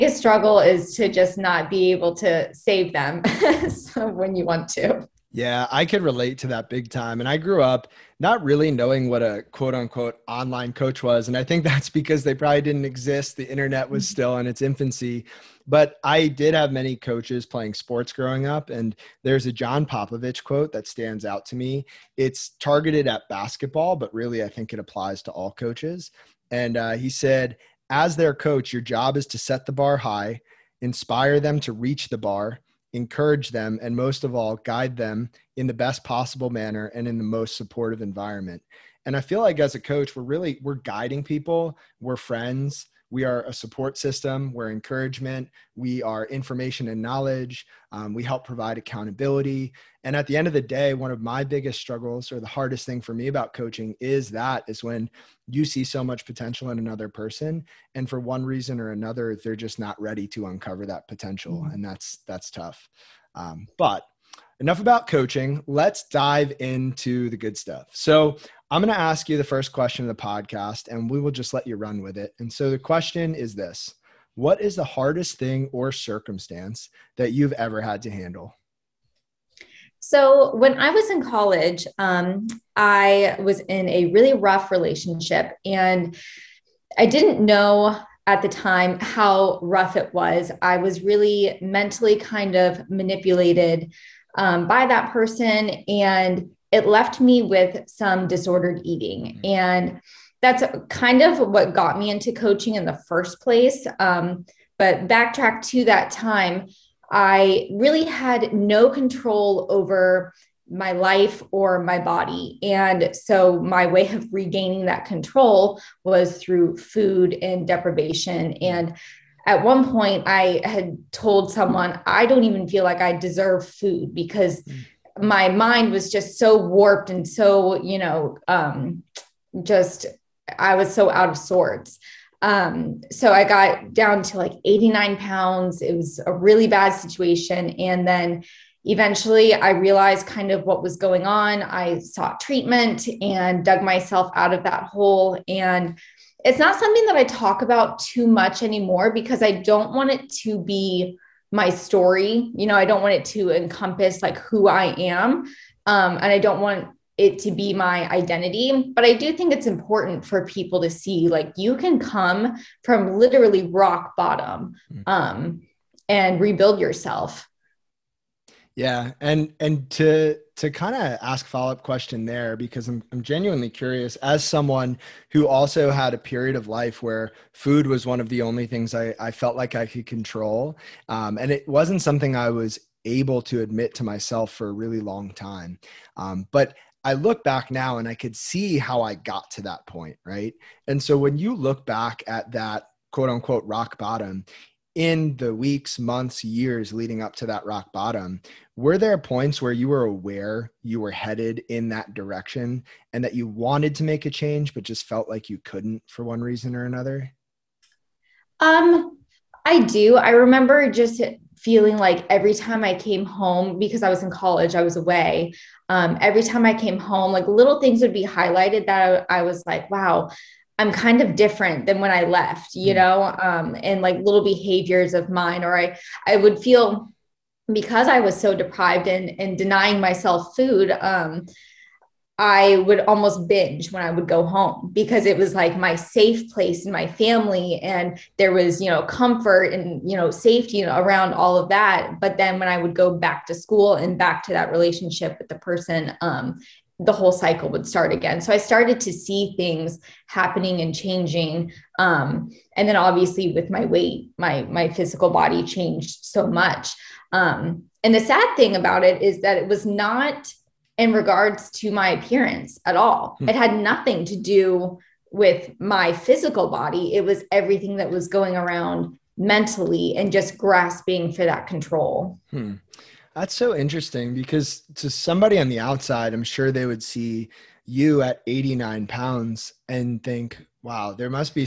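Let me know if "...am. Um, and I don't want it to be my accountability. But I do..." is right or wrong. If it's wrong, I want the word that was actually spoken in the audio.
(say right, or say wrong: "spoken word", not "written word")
wrong: "identity", not "accountability".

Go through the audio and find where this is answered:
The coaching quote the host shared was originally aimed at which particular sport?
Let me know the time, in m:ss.
0:23.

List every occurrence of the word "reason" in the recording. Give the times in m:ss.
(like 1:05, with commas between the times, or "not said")
0:58, 3:26.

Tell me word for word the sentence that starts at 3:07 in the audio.
I look back now and I could see how I got to that point, right?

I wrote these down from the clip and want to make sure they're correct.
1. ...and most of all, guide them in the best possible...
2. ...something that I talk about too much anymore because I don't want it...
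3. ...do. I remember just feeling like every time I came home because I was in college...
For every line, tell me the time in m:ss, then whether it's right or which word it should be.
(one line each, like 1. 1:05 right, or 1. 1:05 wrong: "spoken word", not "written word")
1. 0:33 right
2. 2:26 right
3. 3:29 right.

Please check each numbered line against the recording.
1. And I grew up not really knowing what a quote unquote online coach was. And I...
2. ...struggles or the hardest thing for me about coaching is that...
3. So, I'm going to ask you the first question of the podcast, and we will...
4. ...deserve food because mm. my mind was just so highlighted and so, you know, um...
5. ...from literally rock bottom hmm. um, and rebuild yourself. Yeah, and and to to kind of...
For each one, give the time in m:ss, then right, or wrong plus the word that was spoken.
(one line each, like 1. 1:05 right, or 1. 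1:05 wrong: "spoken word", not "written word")
1. 0:07 right
2. 0:51 right
3. 1:07 right
4. 2:03 wrong: "warped", not "highlighted"
5. 2:42 right.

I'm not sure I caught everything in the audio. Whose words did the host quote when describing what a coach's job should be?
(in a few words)
John Popovich.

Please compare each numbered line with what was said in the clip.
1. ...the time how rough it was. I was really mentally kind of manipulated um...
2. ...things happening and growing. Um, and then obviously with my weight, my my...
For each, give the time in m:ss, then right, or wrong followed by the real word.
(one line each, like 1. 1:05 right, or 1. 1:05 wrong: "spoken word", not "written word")
1. 1:28 right
2. 4:09 wrong: "changing", not "growing".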